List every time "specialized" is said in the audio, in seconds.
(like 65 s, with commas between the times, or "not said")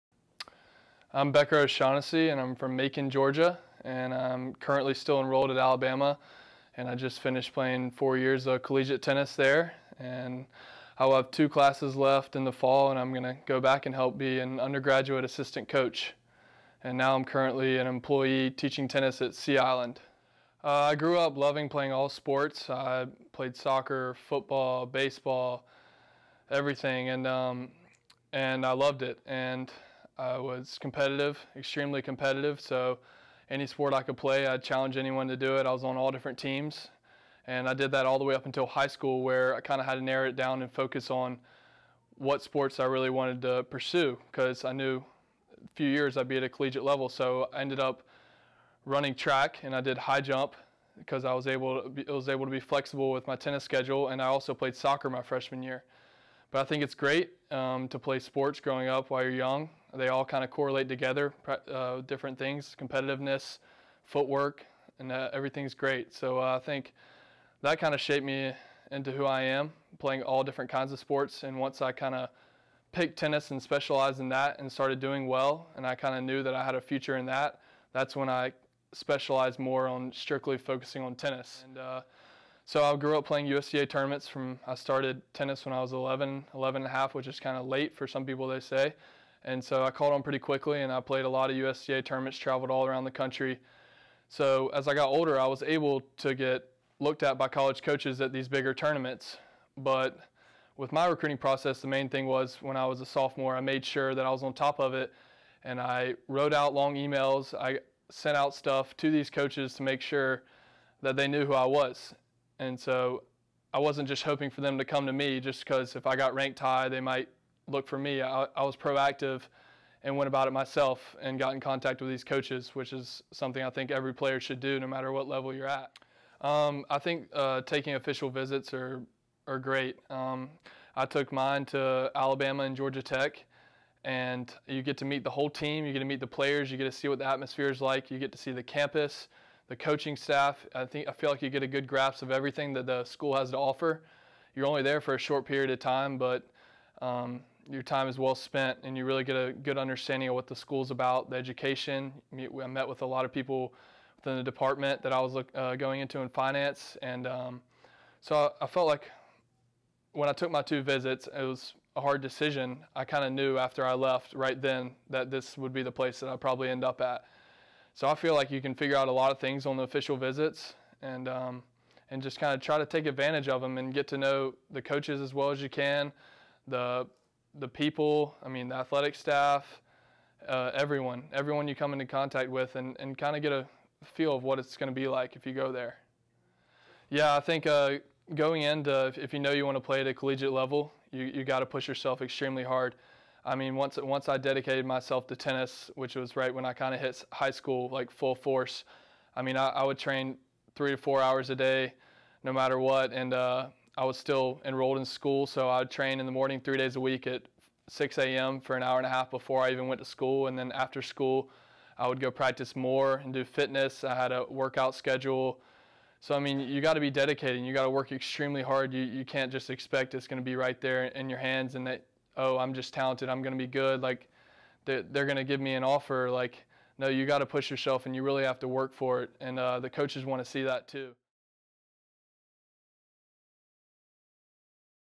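73 s, 78 s.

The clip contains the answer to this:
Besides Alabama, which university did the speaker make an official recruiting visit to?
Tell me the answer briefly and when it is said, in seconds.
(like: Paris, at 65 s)
Georgia Tech, at 132 s.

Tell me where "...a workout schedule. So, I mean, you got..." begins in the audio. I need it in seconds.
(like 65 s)
214 s.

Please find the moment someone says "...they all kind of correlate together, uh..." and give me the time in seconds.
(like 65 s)
59 s.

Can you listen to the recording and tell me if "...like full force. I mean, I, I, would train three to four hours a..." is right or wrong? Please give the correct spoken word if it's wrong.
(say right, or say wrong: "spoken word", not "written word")
right.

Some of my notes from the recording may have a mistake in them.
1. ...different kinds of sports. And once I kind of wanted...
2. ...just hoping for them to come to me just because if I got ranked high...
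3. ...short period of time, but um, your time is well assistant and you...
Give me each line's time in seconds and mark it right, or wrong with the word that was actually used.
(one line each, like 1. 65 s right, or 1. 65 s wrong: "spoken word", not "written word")
1. 70 s wrong: "picked", not "wanted"
2. 114 s right
3. 145 s wrong: "spent", not "assistant".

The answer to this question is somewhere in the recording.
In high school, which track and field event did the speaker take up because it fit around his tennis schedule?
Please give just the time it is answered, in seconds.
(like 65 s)
49 s.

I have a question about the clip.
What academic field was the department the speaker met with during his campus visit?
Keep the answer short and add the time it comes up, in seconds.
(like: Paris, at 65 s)
Finance, at 156 s.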